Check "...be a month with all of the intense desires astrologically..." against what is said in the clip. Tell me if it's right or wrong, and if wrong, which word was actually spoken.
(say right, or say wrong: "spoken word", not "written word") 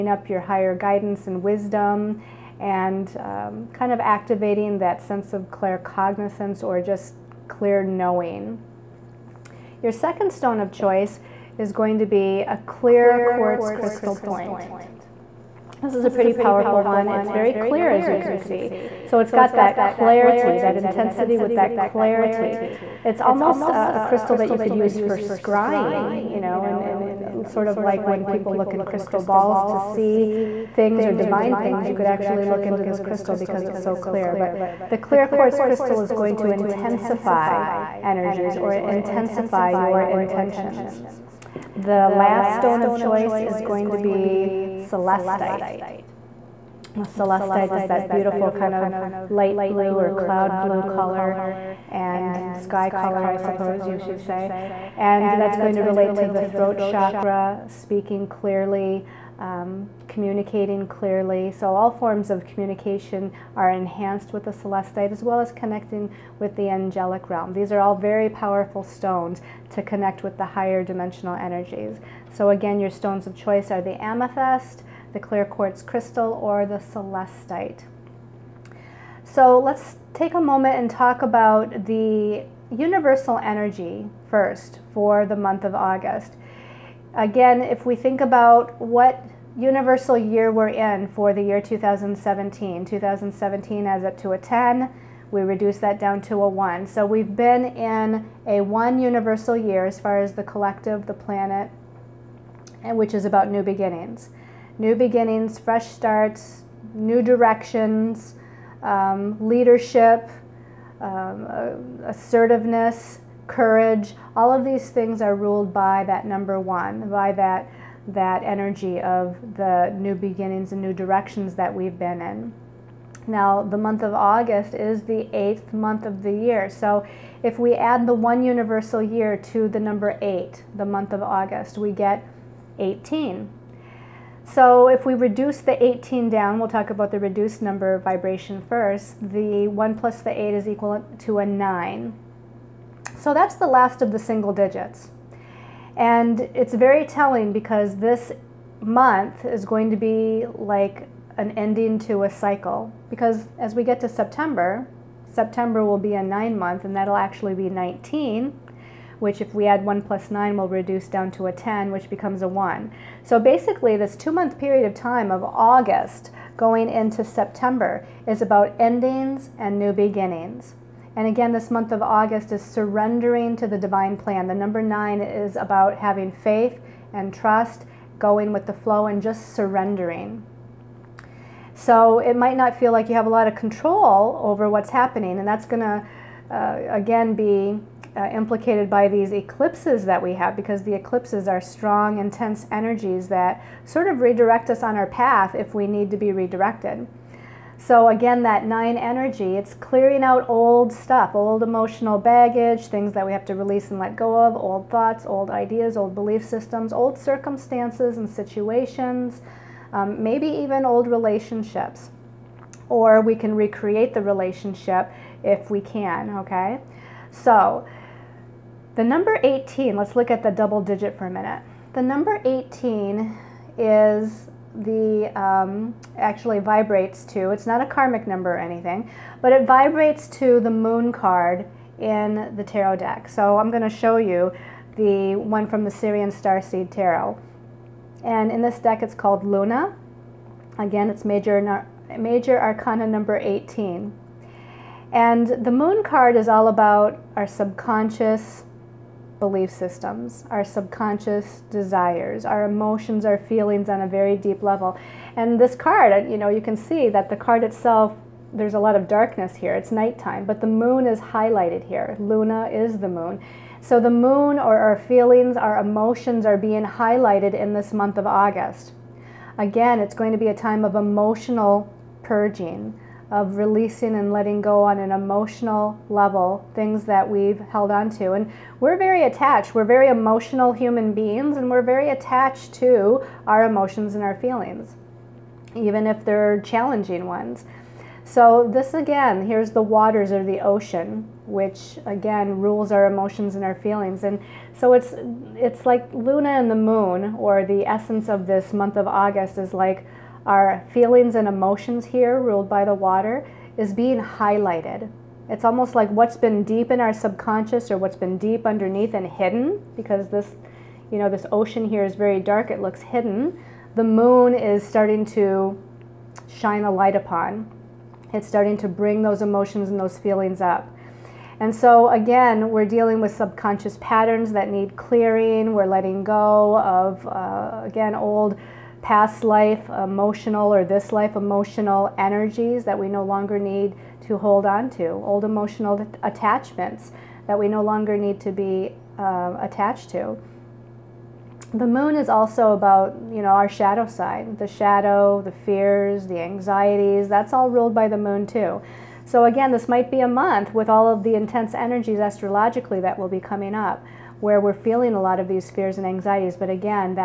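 wrong: "energies", not "desires".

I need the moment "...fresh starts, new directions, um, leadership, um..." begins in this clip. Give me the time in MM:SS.
01:45.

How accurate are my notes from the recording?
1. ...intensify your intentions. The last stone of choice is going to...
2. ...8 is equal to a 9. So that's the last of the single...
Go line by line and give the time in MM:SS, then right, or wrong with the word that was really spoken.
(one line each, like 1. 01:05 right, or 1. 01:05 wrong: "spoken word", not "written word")
1. 00:38 right
2. 02:20 right.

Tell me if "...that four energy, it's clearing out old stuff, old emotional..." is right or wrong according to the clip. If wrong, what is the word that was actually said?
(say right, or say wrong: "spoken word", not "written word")
wrong: "nine", not "four".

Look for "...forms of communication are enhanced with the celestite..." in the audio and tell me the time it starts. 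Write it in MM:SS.
01:01.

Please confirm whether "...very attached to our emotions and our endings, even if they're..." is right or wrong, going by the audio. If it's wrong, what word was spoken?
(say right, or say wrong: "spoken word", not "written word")
wrong: "feelings", not "endings".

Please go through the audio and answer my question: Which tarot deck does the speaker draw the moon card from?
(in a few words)
Sirian Starseed Tarot.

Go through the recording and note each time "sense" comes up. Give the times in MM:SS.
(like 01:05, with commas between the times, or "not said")
00:05.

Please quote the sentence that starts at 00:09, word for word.
Your second stone of choice is going to be a clear quartz crystal point.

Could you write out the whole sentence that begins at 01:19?
So let's take a moment and talk about the universal energy first for the month of August.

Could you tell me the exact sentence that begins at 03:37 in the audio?
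So the number 18, let's look at the double digit for a minute.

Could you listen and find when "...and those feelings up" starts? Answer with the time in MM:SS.
05:19.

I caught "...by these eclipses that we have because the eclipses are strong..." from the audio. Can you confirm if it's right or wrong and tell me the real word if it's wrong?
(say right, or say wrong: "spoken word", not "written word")
right.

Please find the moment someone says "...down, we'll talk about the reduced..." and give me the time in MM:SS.
02:16.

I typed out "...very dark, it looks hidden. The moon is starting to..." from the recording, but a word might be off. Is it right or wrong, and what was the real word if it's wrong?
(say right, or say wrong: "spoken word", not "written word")
right.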